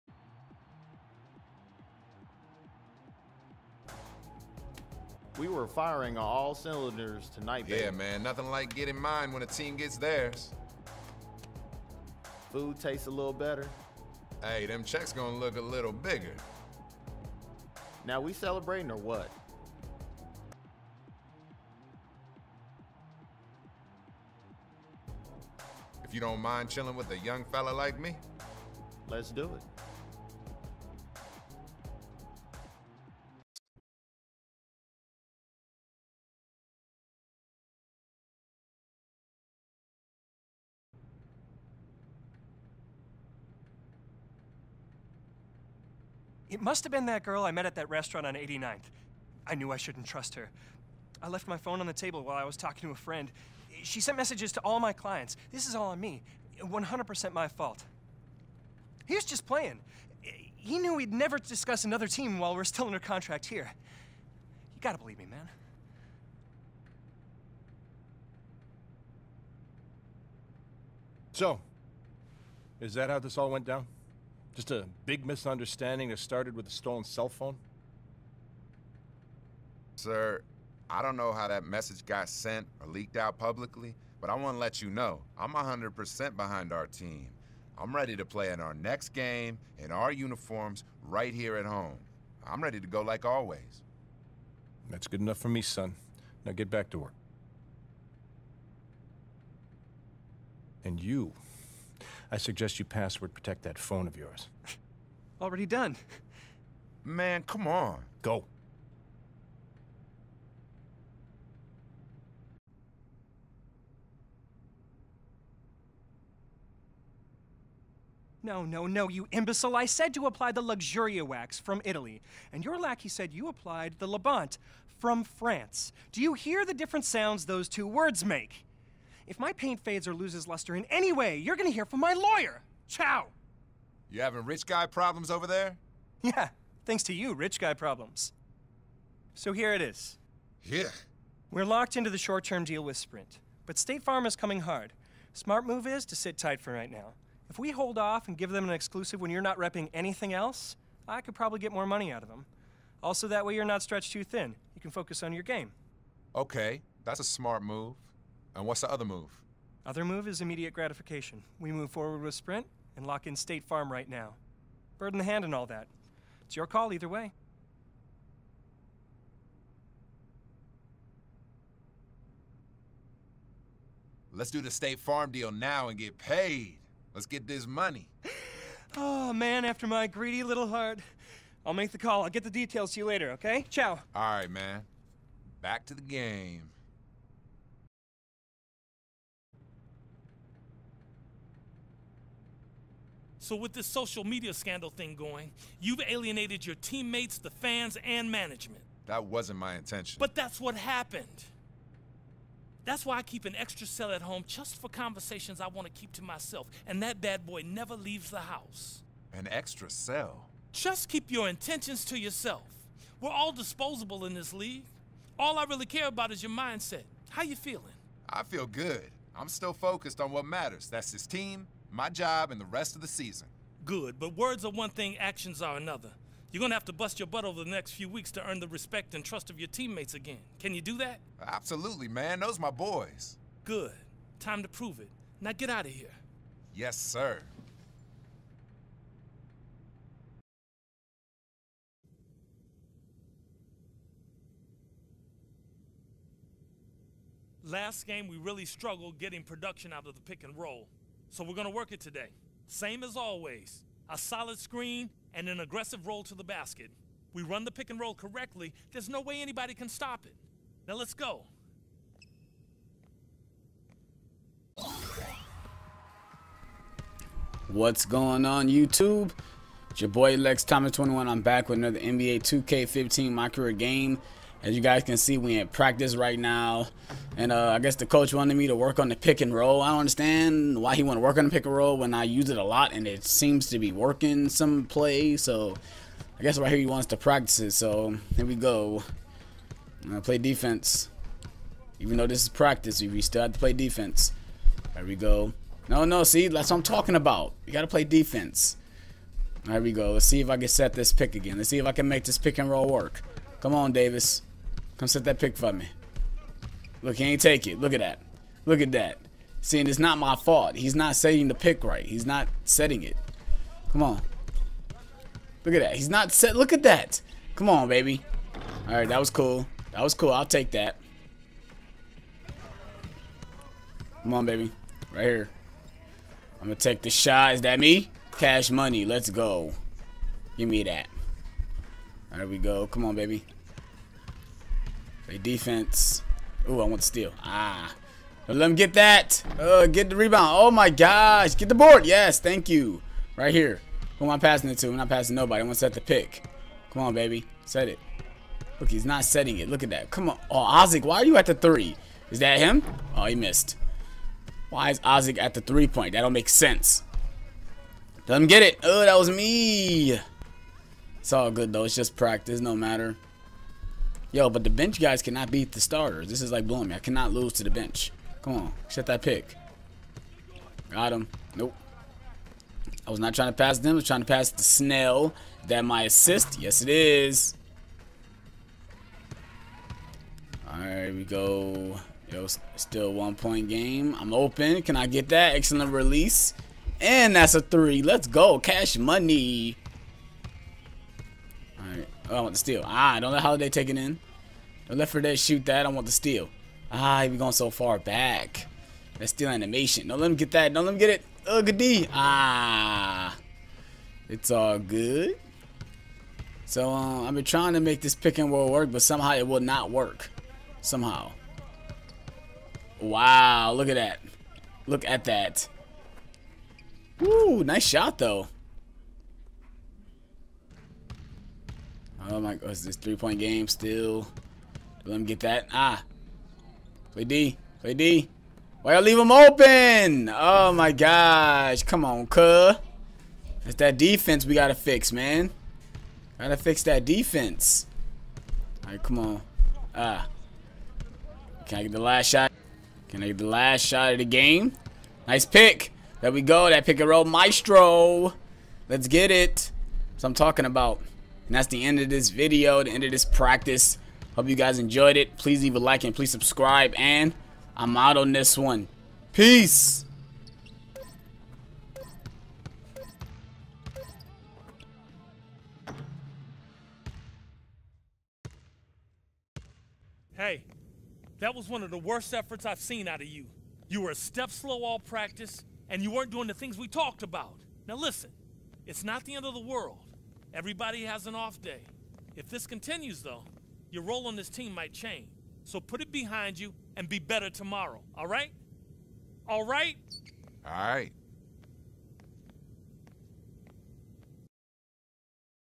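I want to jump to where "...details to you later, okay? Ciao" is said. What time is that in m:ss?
3:02.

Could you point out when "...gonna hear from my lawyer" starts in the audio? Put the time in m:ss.
2:11.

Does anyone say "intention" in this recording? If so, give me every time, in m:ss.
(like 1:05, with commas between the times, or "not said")
3:19, 3:31.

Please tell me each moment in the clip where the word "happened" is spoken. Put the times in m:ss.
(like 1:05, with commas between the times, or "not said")
3:20.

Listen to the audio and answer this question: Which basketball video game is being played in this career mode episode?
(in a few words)
NBA 2K15.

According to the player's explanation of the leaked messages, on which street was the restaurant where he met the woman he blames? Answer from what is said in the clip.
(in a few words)
89th.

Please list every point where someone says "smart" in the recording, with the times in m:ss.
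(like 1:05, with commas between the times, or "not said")
2:25, 2:37.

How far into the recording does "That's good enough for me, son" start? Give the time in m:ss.
1:34.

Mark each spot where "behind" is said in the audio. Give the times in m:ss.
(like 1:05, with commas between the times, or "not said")
1:26, 8:06.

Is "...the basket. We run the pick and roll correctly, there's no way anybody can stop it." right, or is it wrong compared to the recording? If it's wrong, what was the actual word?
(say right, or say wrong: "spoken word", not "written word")
right.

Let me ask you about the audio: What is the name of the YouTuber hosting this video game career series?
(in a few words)
Lex Thomas 21.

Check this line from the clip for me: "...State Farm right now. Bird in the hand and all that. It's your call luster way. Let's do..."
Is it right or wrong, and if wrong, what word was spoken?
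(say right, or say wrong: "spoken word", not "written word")
wrong: "either", not "luster".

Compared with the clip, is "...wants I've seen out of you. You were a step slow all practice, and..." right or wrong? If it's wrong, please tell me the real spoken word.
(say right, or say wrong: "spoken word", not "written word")
wrong: "efforts", not "wants".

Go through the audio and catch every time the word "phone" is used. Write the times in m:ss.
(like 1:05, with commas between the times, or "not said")
0:51, 1:17, 1:43.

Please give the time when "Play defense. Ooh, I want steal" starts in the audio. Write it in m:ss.
5:35.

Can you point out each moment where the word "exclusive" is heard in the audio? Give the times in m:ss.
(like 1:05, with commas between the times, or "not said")
2:28.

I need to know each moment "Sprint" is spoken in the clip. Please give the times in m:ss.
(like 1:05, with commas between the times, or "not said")
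2:22, 2:42.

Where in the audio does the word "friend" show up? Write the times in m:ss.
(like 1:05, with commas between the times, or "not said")
0:52.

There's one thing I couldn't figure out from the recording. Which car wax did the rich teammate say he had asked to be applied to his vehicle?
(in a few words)
Luxuria.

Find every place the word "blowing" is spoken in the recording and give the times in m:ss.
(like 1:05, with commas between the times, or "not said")
6:06.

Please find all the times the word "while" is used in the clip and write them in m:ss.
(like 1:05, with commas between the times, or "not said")
0:52, 1:02.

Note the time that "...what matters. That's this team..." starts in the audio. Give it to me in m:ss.
3:40.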